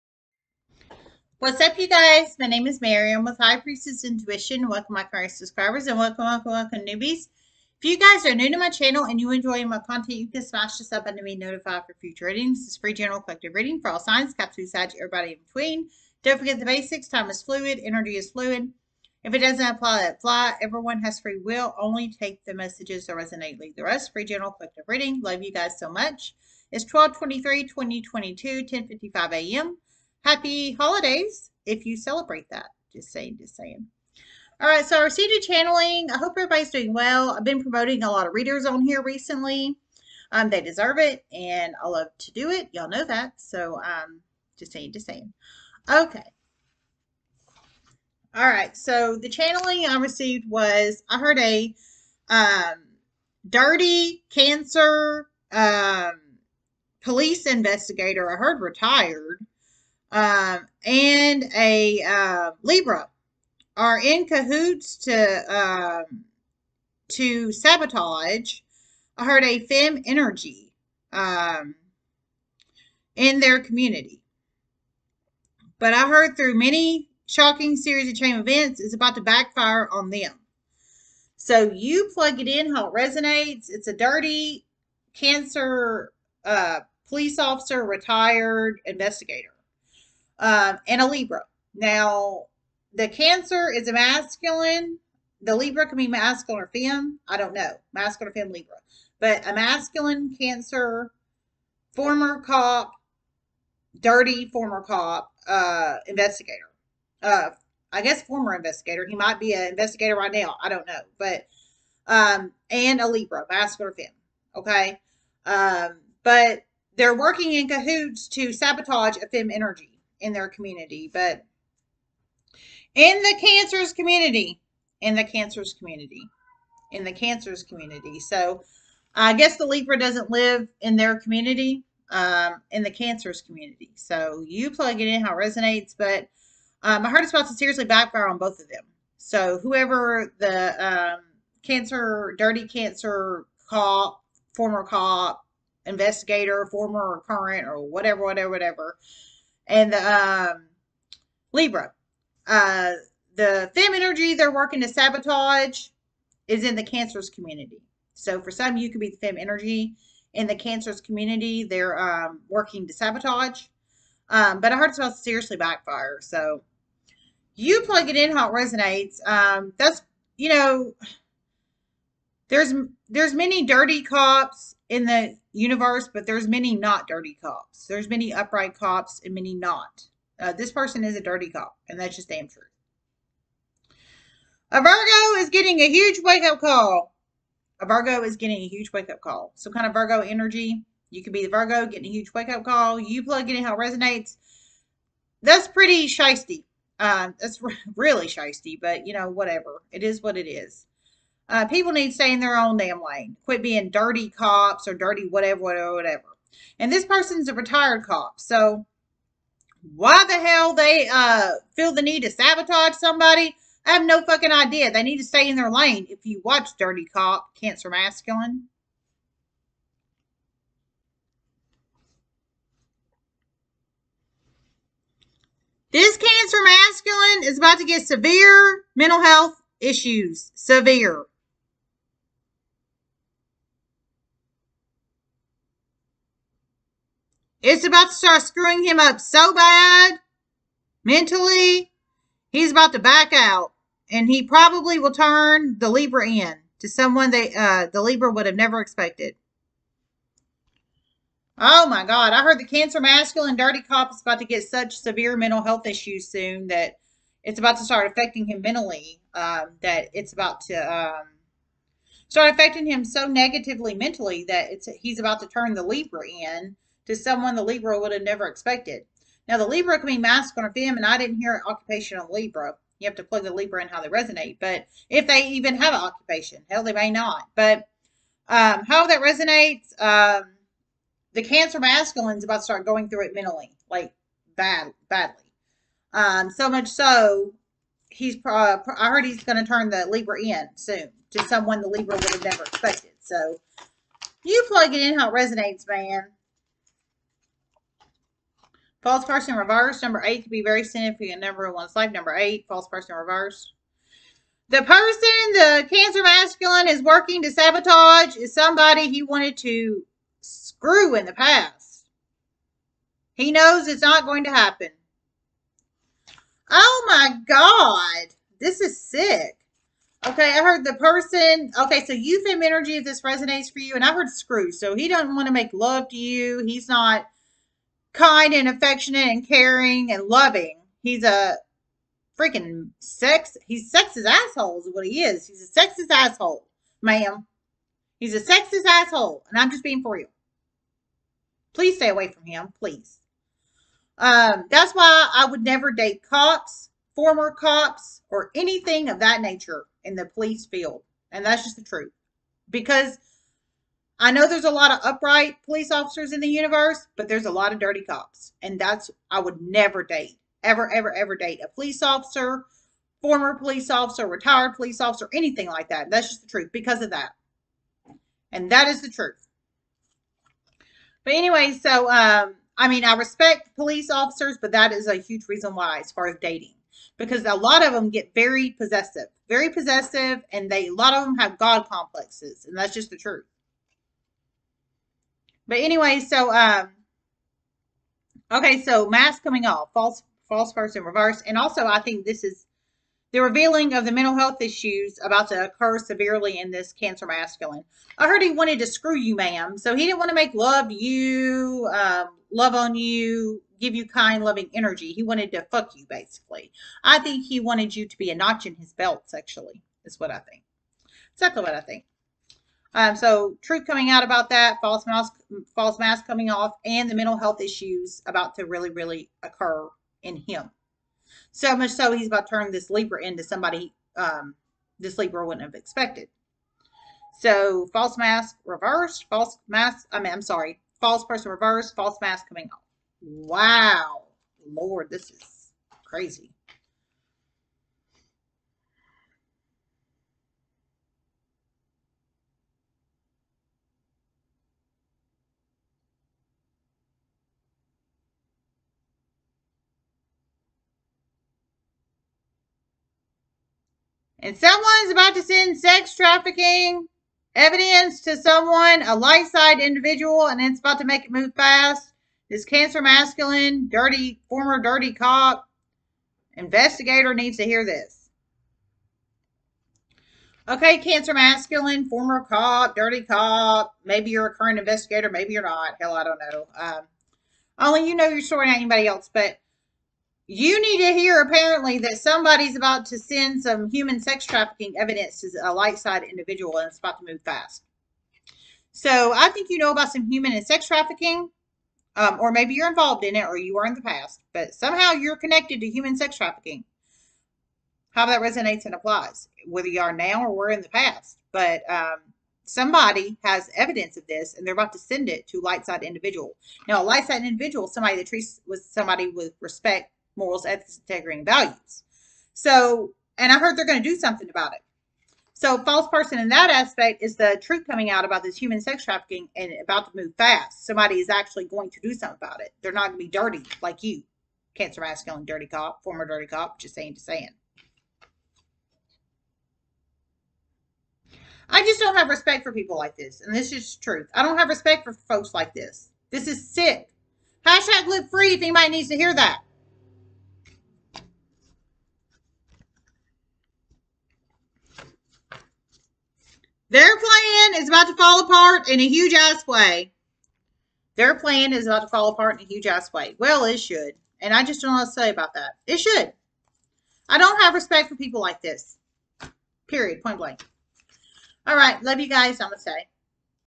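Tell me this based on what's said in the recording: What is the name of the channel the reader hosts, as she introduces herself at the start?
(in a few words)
High Priestess Intuition.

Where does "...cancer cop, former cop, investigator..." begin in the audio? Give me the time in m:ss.
2:22.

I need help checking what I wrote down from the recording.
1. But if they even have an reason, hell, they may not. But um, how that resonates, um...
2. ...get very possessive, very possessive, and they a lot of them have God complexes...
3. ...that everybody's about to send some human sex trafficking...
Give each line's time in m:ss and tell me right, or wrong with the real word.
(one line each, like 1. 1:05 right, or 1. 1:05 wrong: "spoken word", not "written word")
1. 4:34 wrong: "occupation", not "reason"
2. 6:18 right
3. 8:01 wrong: "somebody", not "everybody".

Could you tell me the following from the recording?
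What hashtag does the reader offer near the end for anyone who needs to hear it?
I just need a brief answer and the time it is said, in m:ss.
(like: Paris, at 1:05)
Live free, at 8:58.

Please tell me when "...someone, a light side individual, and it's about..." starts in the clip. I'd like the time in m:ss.
7:38.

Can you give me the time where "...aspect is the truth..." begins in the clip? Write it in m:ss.
8:36.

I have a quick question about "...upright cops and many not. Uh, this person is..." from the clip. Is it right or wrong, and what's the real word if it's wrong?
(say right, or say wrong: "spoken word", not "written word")
right.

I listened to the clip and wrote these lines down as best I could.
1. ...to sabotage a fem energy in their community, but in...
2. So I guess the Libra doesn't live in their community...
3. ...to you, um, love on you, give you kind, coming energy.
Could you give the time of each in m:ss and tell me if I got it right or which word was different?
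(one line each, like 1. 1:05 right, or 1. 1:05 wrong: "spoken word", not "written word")
1. 1:58 right
2. 2:08 right
3. 6:40 wrong: "loving", not "coming".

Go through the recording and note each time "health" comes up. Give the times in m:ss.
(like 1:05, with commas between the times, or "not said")
3:49, 4:15, 6:34, 6:57.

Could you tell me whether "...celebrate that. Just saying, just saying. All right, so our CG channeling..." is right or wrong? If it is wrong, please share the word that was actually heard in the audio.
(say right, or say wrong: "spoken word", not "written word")
right.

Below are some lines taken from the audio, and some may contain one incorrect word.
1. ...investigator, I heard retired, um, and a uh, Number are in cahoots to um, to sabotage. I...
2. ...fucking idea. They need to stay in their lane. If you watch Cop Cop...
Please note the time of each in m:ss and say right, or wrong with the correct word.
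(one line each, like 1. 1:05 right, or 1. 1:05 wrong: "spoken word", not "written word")
1. 0:57 wrong: "Libra", not "Number"
2. 3:34 wrong: "Dirty", not "Cop".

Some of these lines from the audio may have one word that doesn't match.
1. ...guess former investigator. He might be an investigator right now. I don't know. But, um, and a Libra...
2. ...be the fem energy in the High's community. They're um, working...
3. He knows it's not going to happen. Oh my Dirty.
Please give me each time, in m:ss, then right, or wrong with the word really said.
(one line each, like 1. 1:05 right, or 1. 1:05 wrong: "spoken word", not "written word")
1. 1:48 right
2. 2:38 wrong: "Cancer", not "High"
3. 5:13 wrong: "God", not "Dirty".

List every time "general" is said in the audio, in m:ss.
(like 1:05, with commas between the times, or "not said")
0:12, 0:24.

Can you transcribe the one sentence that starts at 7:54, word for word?
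Maybe you're a current investigator, maybe you're not.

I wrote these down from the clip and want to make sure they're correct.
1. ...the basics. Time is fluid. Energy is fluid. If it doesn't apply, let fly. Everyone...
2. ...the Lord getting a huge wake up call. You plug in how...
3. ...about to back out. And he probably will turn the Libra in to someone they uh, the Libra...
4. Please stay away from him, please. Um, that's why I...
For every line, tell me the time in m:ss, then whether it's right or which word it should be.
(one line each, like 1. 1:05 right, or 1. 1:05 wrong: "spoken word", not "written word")
1. 0:16 right
2. 3:11 wrong: "Virgo", not "Lord"
3. 4:02 right
4. 5:41 right.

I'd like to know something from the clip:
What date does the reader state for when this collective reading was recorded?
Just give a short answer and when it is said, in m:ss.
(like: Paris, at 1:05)
12-23-2022, at 0:26.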